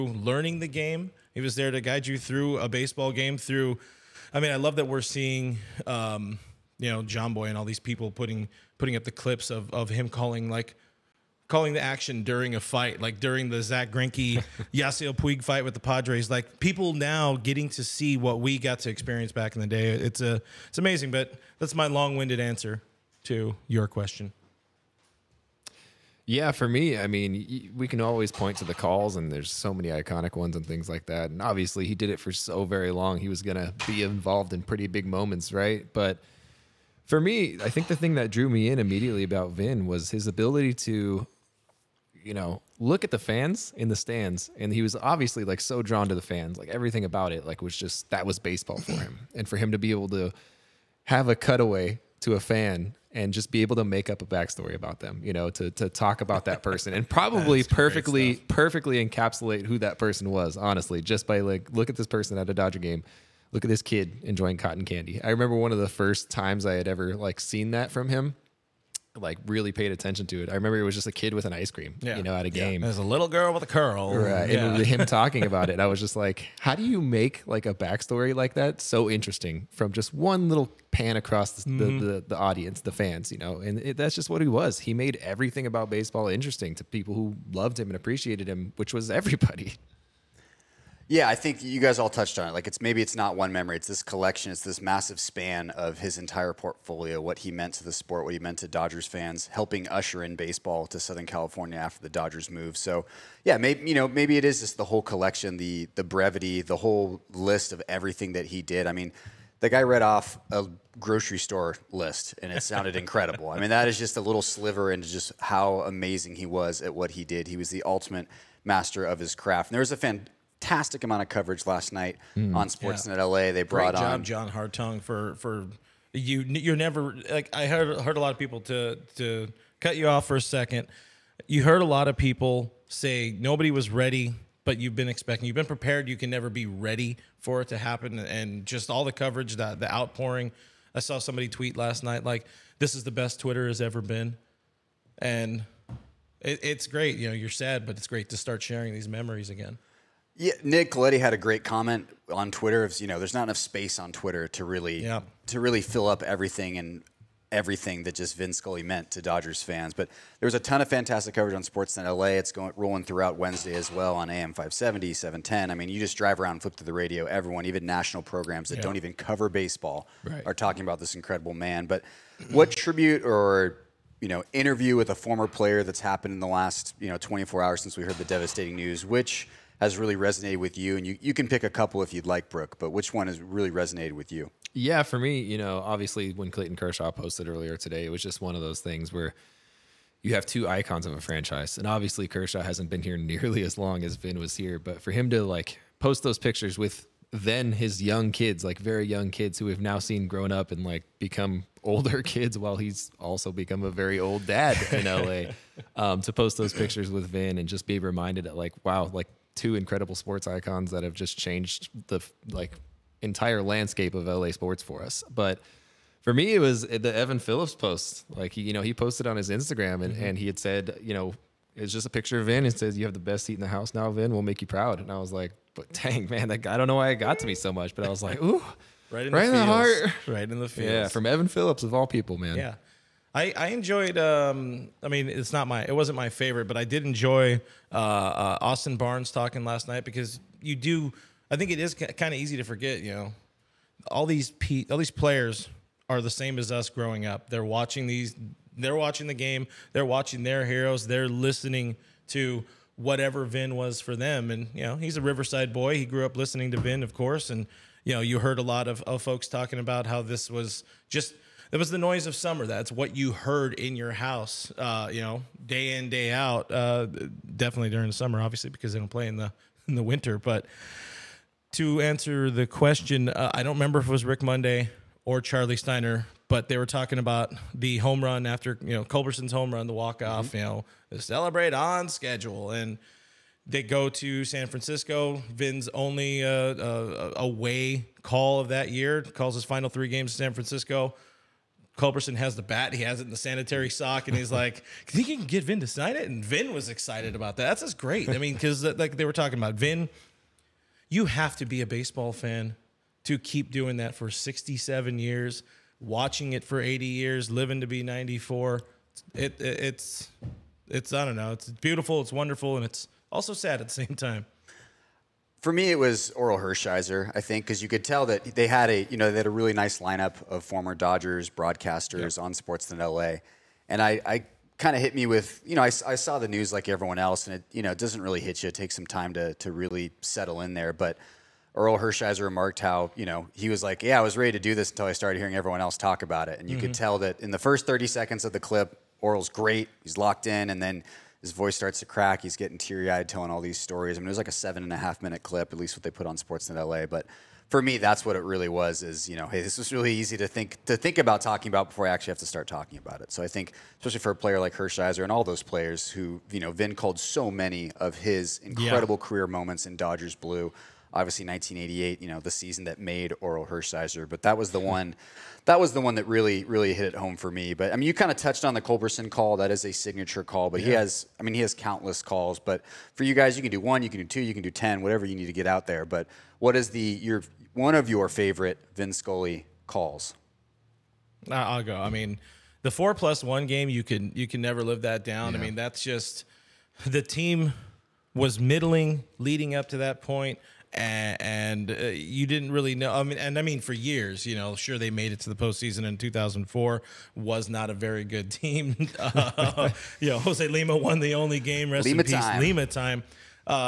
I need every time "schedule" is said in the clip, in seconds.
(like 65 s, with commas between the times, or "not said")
282 s.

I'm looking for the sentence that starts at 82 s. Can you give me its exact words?
the, the, audience, the fans, you know?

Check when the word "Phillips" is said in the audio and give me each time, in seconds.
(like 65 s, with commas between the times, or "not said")
217 s, 231 s.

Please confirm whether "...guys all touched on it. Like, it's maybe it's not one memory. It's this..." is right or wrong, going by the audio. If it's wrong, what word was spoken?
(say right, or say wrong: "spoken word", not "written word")
right.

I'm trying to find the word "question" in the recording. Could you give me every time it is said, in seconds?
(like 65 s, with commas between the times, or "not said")
23 s, 272 s.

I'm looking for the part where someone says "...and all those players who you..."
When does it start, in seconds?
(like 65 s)
355 s.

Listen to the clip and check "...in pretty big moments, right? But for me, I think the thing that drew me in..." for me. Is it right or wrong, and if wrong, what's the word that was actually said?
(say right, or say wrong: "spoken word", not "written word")
right.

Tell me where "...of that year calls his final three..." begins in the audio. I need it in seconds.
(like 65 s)
288 s.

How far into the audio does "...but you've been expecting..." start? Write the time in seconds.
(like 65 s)
134 s.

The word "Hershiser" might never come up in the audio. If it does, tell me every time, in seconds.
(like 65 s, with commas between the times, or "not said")
316 s, 331 s, 354 s, 363 s.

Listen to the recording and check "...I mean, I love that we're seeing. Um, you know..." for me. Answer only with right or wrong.
right.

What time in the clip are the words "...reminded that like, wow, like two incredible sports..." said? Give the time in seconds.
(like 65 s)
207 s.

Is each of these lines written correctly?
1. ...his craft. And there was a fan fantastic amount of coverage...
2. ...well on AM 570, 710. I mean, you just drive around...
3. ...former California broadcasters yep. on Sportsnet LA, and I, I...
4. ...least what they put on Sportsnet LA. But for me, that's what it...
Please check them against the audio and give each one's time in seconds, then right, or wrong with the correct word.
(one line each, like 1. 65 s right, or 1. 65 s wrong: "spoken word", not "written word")
1. 119 s right
2. 163 s right
3. 320 s wrong: "Dodgers", not "California"
4. 345 s right.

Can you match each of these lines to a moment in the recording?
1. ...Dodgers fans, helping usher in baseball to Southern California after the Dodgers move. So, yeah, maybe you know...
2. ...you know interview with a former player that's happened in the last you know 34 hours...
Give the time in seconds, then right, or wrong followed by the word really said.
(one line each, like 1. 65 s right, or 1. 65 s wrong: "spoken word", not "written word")
1. 98 s right
2. 174 s wrong: "24", not "34".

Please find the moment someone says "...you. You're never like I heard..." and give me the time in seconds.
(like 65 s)
126 s.